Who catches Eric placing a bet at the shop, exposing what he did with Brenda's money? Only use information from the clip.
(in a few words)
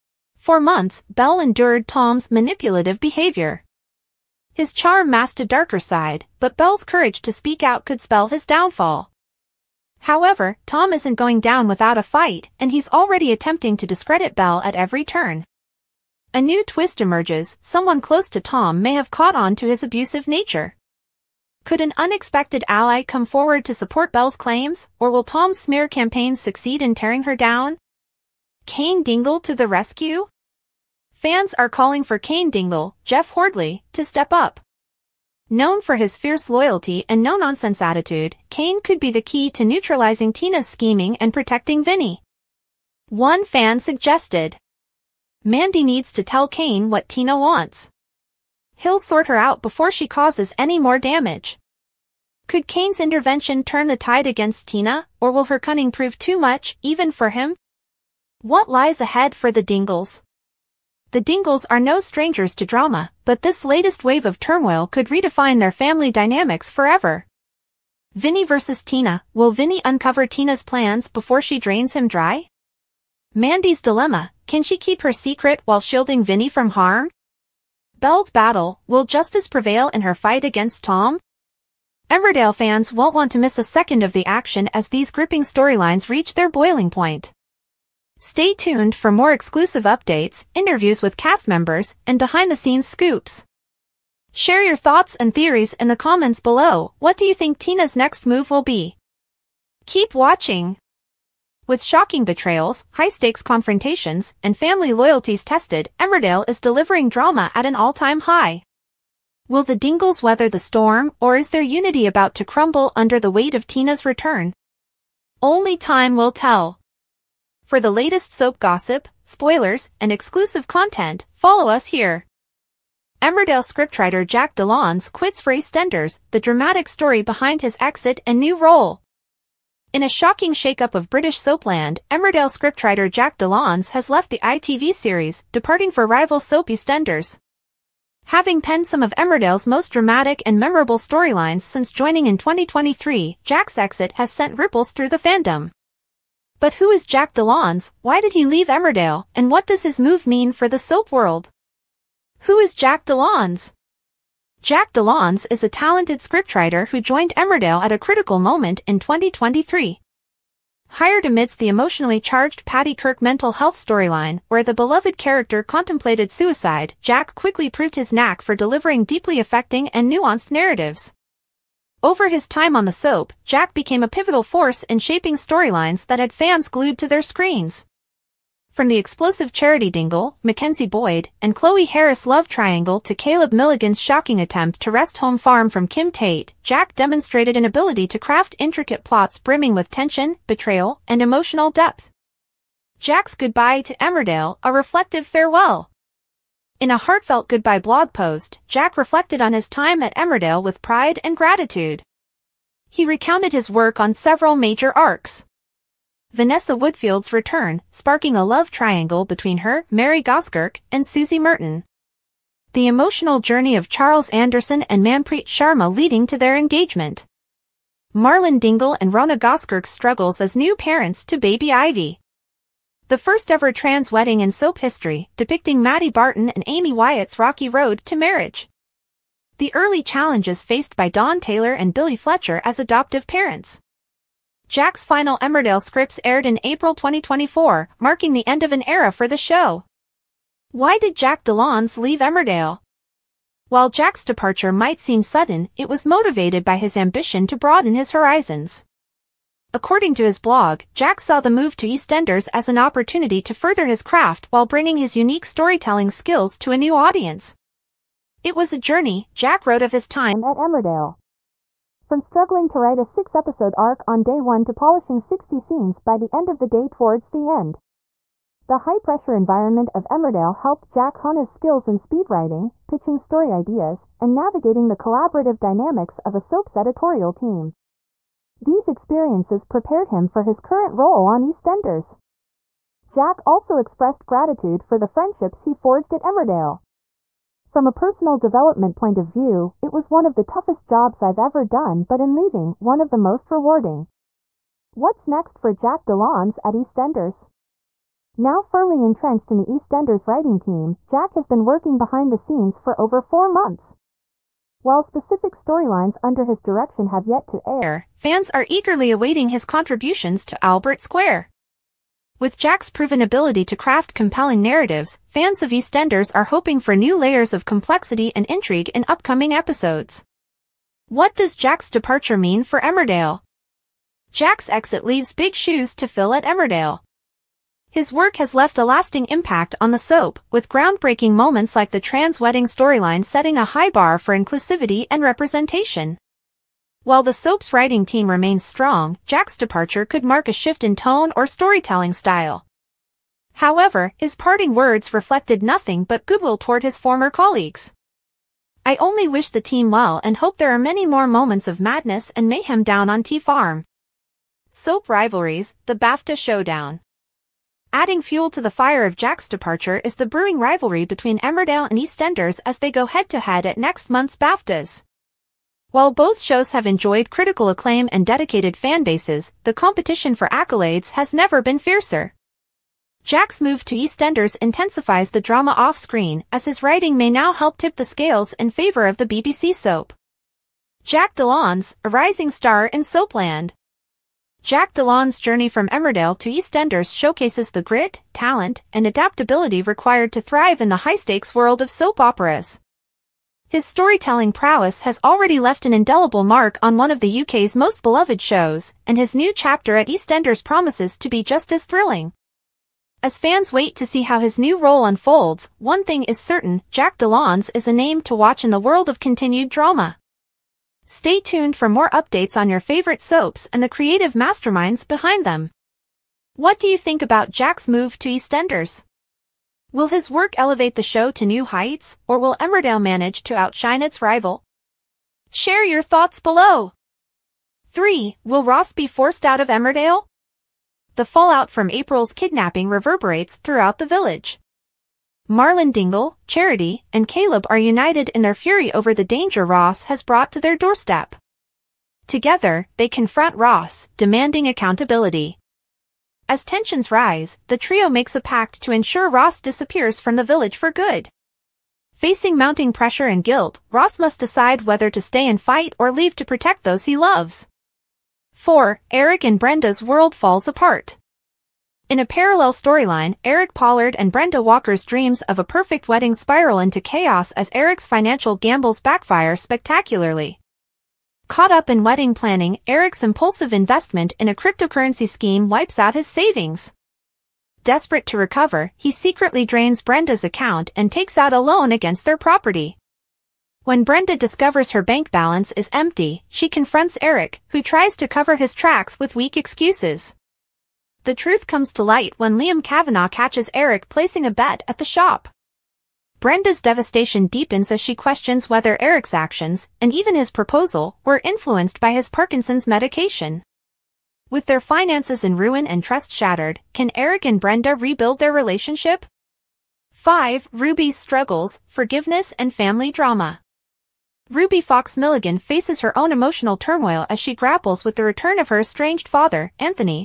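Liam Cavanagh.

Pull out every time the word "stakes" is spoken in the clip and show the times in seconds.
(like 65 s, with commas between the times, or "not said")
102 s, 391 s.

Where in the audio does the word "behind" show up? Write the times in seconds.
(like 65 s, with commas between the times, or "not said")
92 s, 127 s, 301 s, 415 s.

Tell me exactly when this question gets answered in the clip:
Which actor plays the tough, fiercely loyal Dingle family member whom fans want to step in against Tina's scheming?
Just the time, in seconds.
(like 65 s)
33 s.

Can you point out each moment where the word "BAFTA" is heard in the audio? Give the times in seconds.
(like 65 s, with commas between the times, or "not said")
355 s, 364 s.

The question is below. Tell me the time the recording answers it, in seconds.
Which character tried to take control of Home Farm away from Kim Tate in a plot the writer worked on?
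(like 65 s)
183 s.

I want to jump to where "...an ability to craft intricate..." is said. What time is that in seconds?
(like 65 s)
187 s.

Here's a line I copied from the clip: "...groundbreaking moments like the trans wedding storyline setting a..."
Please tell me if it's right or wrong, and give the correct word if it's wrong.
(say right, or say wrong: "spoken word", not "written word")
right.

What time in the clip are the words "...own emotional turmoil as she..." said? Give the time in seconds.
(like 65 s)
516 s.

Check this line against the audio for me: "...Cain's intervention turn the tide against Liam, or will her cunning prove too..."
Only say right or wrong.
wrong.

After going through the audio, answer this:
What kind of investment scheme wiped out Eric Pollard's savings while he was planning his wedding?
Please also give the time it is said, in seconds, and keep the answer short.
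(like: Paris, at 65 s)
cryptocurrency, at 474 s.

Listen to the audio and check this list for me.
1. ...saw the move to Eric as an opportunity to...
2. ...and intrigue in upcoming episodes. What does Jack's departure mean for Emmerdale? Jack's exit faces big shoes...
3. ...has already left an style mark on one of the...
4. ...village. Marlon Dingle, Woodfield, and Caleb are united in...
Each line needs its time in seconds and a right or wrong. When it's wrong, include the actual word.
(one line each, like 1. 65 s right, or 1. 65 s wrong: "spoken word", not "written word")
1. 251 s wrong: "EastEnders", not "Eric"
2. 318 s wrong: "leaves", not "faces"
3. 395 s wrong: "indelible", not "style"
4. 434 s wrong: "Charity", not "Woodfield".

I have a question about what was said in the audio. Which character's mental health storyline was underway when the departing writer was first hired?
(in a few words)
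Paddy Kirk.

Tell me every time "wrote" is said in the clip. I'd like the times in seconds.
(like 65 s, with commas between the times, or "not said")
259 s.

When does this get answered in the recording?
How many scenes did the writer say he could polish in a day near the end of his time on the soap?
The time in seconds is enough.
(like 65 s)
265 s.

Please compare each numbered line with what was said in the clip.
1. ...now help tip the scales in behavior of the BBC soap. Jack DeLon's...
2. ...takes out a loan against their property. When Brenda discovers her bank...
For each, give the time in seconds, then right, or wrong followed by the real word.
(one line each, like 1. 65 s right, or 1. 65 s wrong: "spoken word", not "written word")
1. 377 s wrong: "favor", not "behavior"
2. 481 s right.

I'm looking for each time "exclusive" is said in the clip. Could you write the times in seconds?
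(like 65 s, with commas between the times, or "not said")
89 s, 120 s.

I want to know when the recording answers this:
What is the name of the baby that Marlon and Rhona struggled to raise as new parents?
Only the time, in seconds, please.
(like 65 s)
221 s.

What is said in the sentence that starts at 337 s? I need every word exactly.
While the soap's writing team remains strong, Jack's departure could mark a shift in tone or storytelling style.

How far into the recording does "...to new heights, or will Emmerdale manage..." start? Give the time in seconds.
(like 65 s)
421 s.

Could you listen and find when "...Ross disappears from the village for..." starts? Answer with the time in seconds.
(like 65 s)
449 s.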